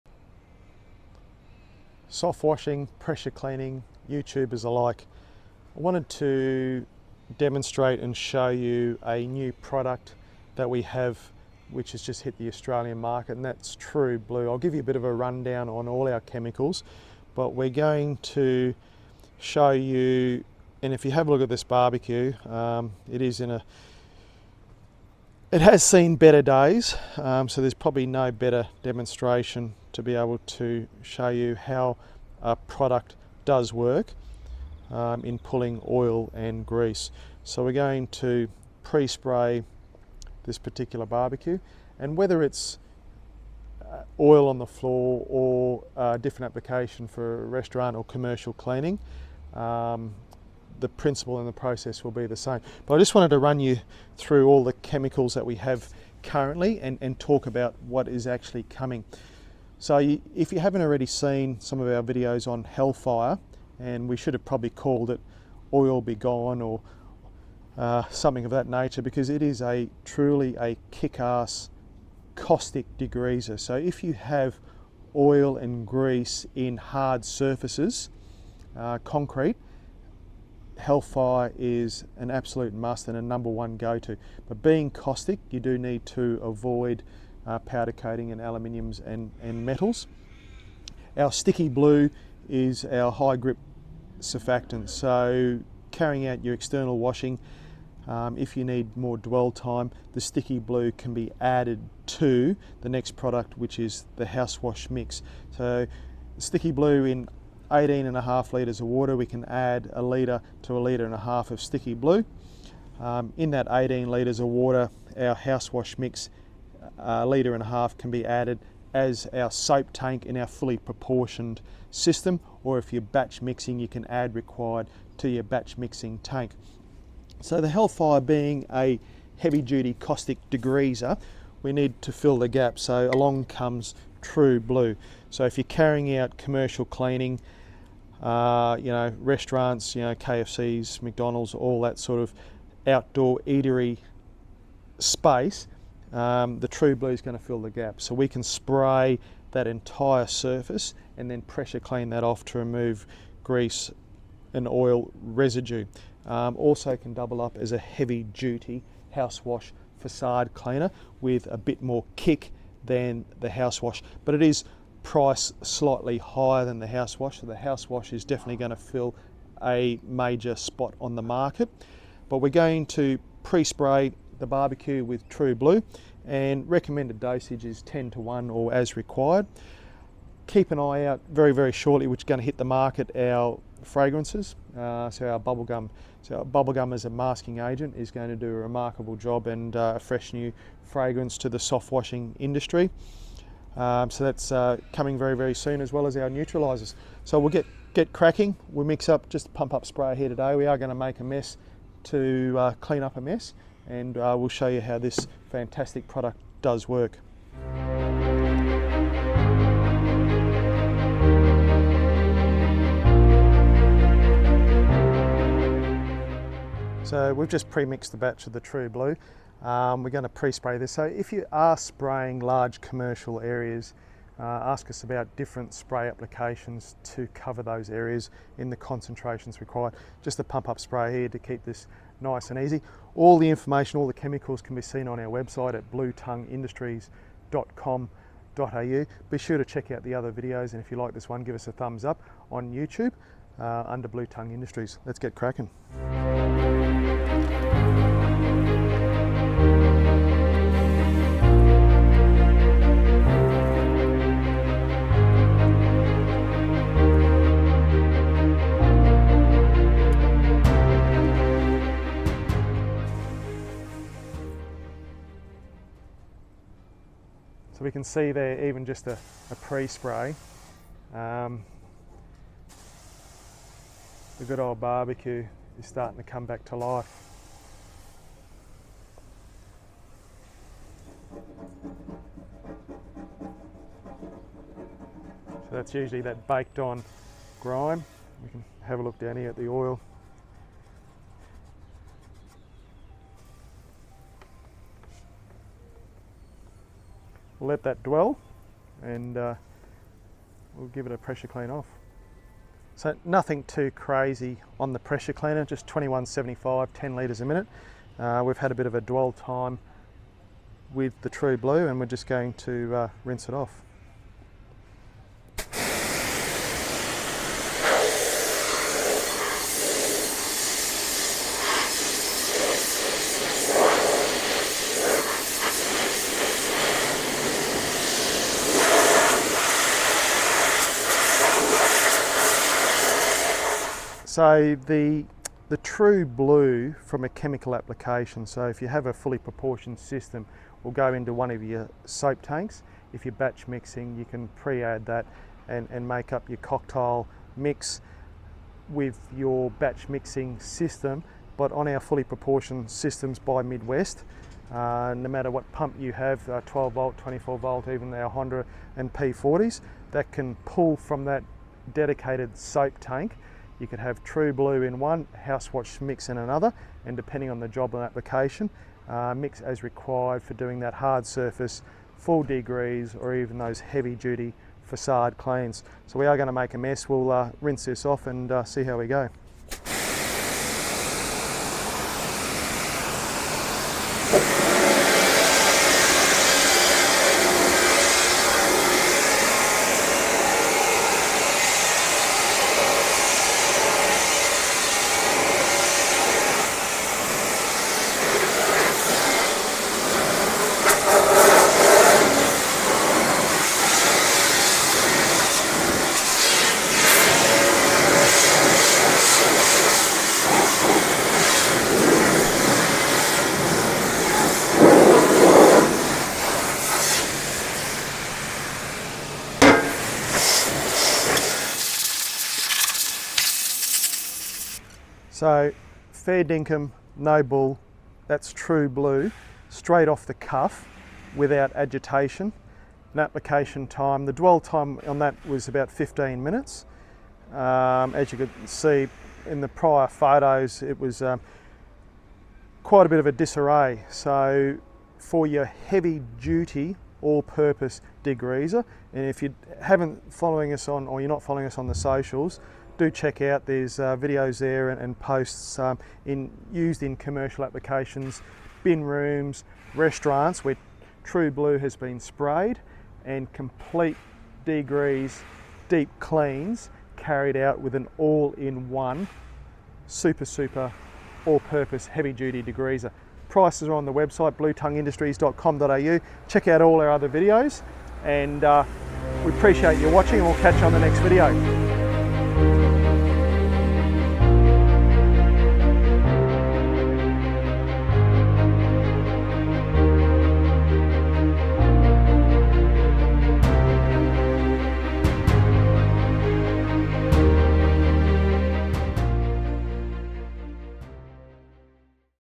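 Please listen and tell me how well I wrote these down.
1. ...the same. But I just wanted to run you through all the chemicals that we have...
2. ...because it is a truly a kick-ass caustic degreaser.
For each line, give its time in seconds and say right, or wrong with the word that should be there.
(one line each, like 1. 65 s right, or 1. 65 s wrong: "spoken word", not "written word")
1. 52 s right
2. 69 s right.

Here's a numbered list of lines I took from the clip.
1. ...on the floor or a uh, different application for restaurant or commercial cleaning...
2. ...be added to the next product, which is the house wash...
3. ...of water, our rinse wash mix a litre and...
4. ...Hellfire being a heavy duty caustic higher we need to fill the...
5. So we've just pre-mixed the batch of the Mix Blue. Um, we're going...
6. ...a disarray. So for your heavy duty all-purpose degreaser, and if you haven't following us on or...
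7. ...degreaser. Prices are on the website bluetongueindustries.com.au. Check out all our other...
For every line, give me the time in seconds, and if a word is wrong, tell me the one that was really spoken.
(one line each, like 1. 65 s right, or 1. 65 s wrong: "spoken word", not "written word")
1. 44 s right
2. 101 s right
3. 114 s wrong: "house", not "rinse"
4. 127 s wrong: "degreaser", not "higher"
5. 217 s wrong: "True", not "Mix"
6. 443 s right
7. 472 s right.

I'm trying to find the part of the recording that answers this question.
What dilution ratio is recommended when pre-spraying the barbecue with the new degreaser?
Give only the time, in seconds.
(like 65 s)
177 s.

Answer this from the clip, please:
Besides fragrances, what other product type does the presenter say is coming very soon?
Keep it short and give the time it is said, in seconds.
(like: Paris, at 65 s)
Neutralizers, at 196 s.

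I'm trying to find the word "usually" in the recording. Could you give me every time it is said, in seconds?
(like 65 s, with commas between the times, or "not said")
285 s.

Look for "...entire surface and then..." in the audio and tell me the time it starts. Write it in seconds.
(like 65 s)
149 s.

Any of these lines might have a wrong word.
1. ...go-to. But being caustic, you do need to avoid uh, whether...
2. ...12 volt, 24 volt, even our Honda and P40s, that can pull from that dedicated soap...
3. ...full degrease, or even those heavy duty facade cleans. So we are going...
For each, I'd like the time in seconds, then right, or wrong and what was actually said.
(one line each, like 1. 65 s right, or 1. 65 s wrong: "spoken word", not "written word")
1. 83 s wrong: "powder", not "whether"
2. 356 s right
3. 372 s right.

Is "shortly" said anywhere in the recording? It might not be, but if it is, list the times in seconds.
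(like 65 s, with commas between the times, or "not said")
181 s.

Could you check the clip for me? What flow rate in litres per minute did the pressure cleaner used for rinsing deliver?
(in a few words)
10 litres a minute.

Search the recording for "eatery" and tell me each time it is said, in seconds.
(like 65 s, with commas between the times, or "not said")
143 s.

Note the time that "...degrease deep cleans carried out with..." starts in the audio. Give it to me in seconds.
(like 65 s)
464 s.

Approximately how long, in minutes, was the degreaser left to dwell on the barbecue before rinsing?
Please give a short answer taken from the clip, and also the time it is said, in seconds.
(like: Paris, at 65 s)
15 minutes, at 435 s.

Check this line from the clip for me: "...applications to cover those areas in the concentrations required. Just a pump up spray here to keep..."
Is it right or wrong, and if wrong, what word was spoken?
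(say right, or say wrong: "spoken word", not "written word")
right.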